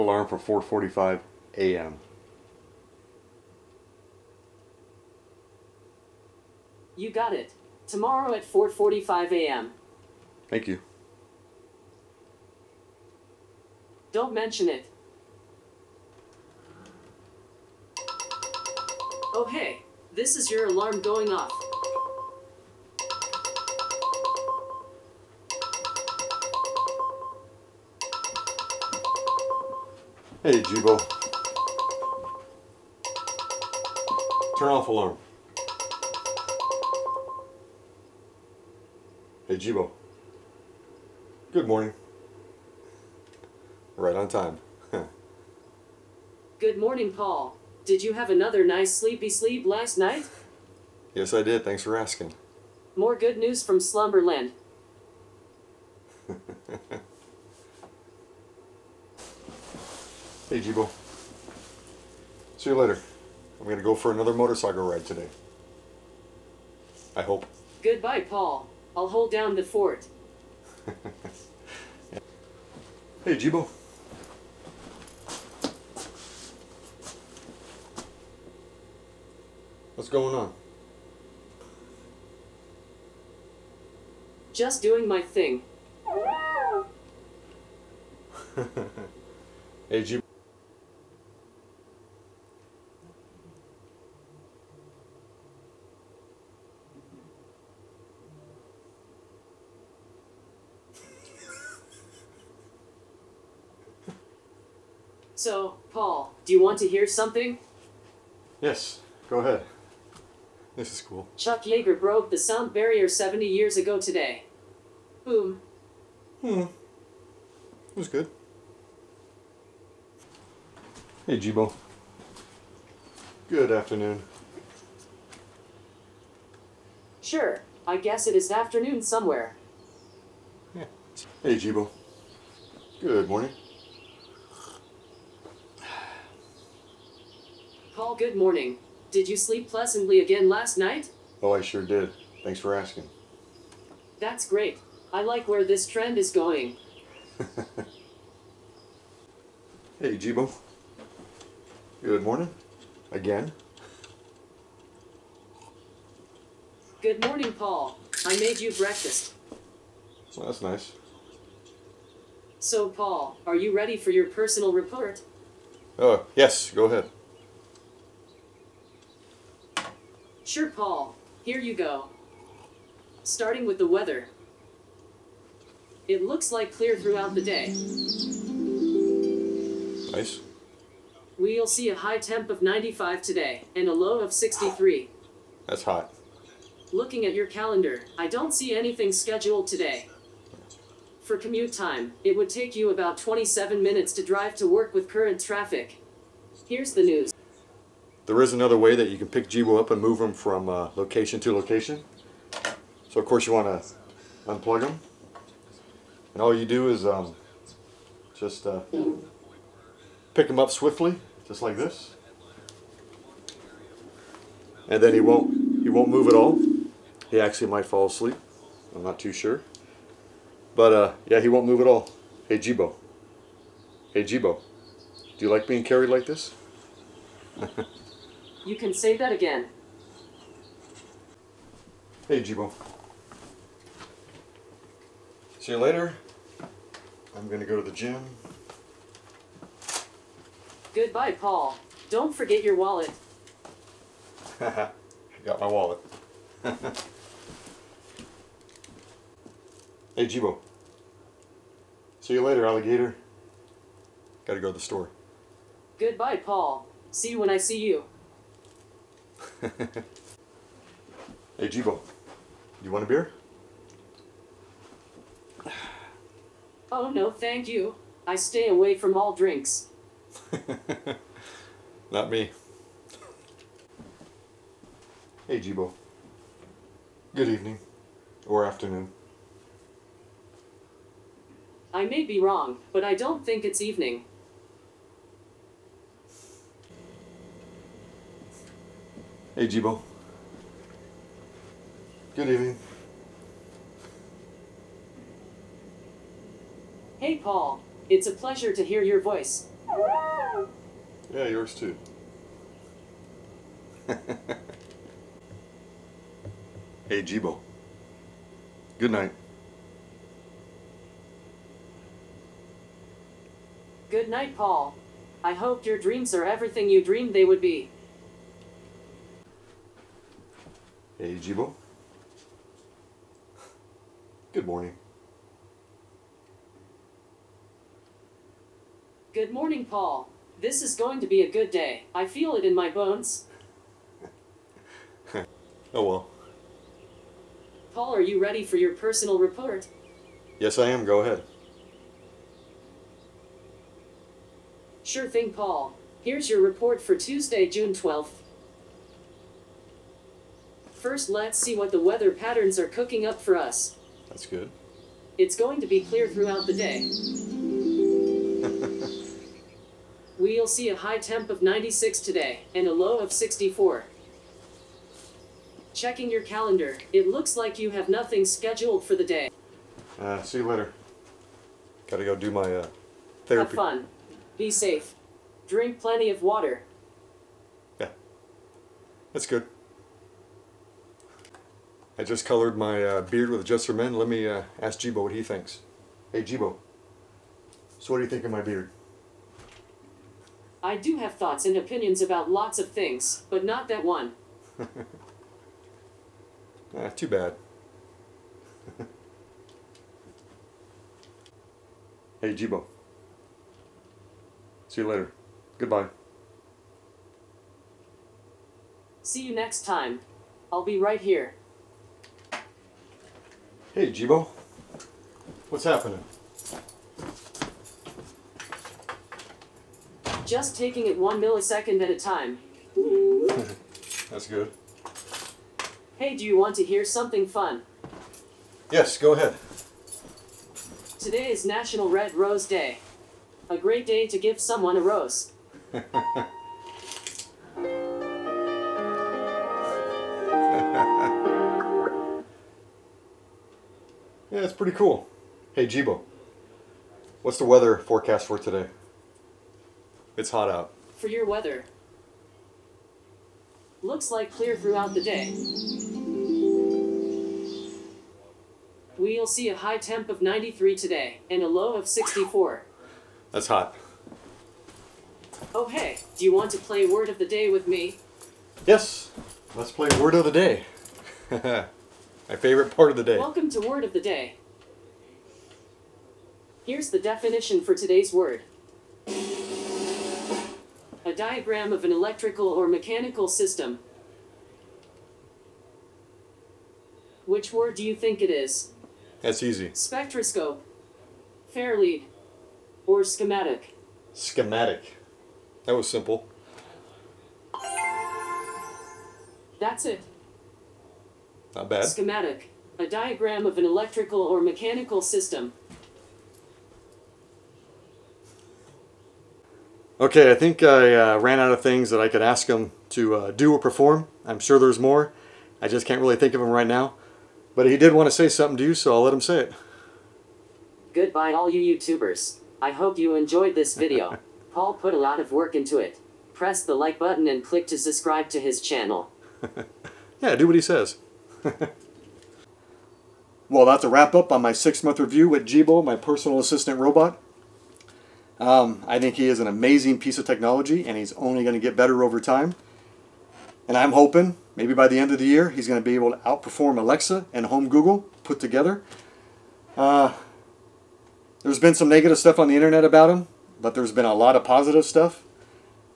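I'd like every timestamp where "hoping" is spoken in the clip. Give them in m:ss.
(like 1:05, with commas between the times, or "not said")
9:04.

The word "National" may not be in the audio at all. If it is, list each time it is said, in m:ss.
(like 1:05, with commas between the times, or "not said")
7:11.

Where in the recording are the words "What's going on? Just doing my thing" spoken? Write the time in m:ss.
1:19.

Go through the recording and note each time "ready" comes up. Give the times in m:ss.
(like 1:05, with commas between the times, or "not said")
2:43, 5:38.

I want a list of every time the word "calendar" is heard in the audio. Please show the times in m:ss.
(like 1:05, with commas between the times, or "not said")
3:07, 6:06.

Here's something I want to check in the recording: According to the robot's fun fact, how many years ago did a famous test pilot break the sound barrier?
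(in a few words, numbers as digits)
70.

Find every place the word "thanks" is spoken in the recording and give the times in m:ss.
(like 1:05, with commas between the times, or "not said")
0:10, 0:51, 2:22, 4:27.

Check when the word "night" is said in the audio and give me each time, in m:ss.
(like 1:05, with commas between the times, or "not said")
0:49, 2:20, 5:09, 5:14.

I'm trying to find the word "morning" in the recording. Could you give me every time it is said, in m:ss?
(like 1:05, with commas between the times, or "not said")
0:41, 0:46, 2:13, 2:18, 2:32, 2:37, 5:24, 5:29.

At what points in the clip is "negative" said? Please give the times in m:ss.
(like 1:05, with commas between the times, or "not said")
9:12.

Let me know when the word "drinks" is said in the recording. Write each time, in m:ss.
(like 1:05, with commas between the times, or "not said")
4:29, 6:15.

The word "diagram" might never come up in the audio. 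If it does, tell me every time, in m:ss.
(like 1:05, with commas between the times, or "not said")
8:01, 8:23.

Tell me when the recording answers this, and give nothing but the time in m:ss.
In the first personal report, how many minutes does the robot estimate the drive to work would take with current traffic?
3:13.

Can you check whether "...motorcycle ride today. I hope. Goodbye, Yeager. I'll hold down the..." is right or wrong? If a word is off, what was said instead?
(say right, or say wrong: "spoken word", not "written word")
wrong: "Paul", not "Yeager".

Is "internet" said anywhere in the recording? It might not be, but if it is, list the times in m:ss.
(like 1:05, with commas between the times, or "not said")
9:12.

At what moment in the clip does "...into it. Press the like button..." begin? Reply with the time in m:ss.
8:45.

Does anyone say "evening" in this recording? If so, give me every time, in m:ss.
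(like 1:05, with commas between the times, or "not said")
4:37, 4:43, 4:52.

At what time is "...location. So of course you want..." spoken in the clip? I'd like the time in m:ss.
3:21.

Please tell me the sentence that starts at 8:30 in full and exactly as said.
Okay, I think I uh, ran out of things that I could ask him to uh, do or perform.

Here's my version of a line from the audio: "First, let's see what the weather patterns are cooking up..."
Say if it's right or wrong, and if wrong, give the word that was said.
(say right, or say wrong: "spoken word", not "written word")
right.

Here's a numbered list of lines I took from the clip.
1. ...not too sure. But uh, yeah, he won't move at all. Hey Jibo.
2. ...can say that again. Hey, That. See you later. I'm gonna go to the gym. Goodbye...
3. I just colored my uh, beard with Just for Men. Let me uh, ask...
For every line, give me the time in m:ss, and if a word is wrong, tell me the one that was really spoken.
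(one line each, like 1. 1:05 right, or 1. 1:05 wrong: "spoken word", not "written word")
1. 3:39 right
2. 3:48 wrong: "Jibo", not "That"
3. 6:22 right.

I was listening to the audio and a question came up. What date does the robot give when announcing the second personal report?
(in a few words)
Tuesday, June 12th.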